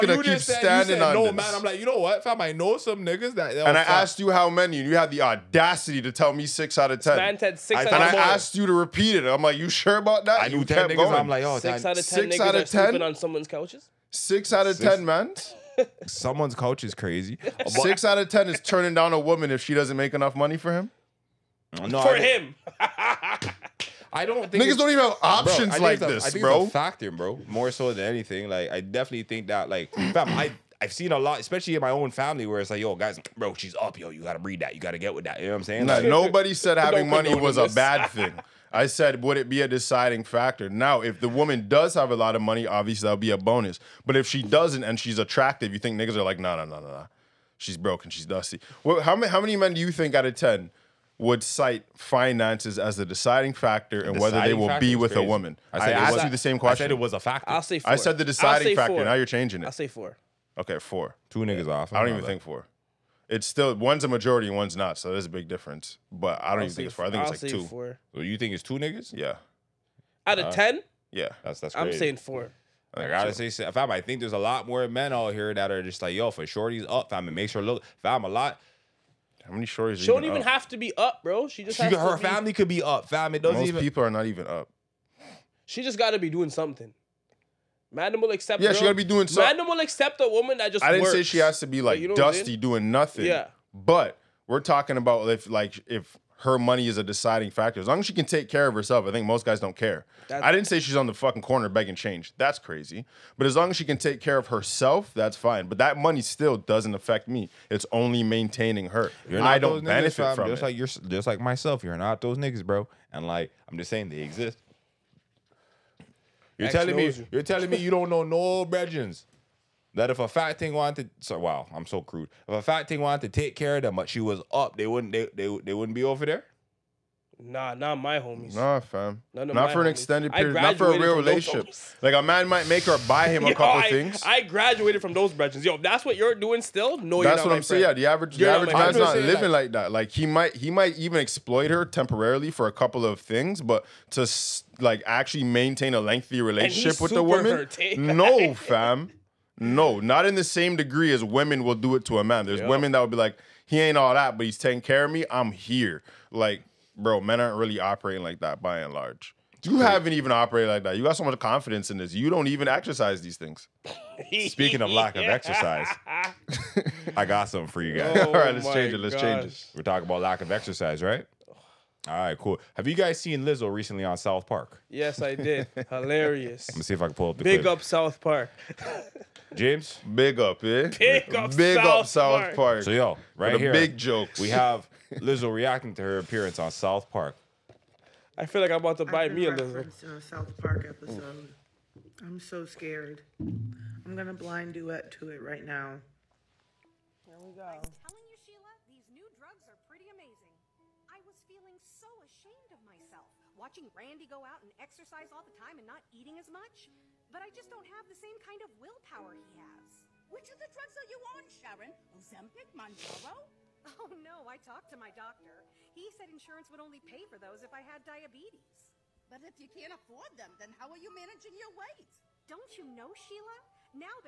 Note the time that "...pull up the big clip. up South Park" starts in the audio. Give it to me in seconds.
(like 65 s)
177 s.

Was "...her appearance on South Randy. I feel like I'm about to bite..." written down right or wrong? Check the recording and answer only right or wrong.
wrong.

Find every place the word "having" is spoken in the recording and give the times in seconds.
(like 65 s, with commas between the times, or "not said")
36 s.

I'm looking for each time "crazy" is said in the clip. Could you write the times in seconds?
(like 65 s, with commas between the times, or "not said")
16 s, 55 s, 71 s, 102 s.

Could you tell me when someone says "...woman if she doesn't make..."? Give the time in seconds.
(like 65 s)
19 s.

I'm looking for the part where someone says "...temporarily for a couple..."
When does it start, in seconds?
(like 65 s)
141 s.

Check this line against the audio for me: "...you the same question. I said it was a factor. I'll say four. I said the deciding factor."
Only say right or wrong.
right.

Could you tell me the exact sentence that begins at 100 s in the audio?
That's I didn't say she's on the fucking corner begging change.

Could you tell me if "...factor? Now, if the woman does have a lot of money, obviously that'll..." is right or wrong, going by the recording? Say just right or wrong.
right.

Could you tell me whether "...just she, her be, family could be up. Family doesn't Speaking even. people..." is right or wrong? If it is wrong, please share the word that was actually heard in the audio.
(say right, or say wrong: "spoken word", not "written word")
wrong: "Most", not "Speaking".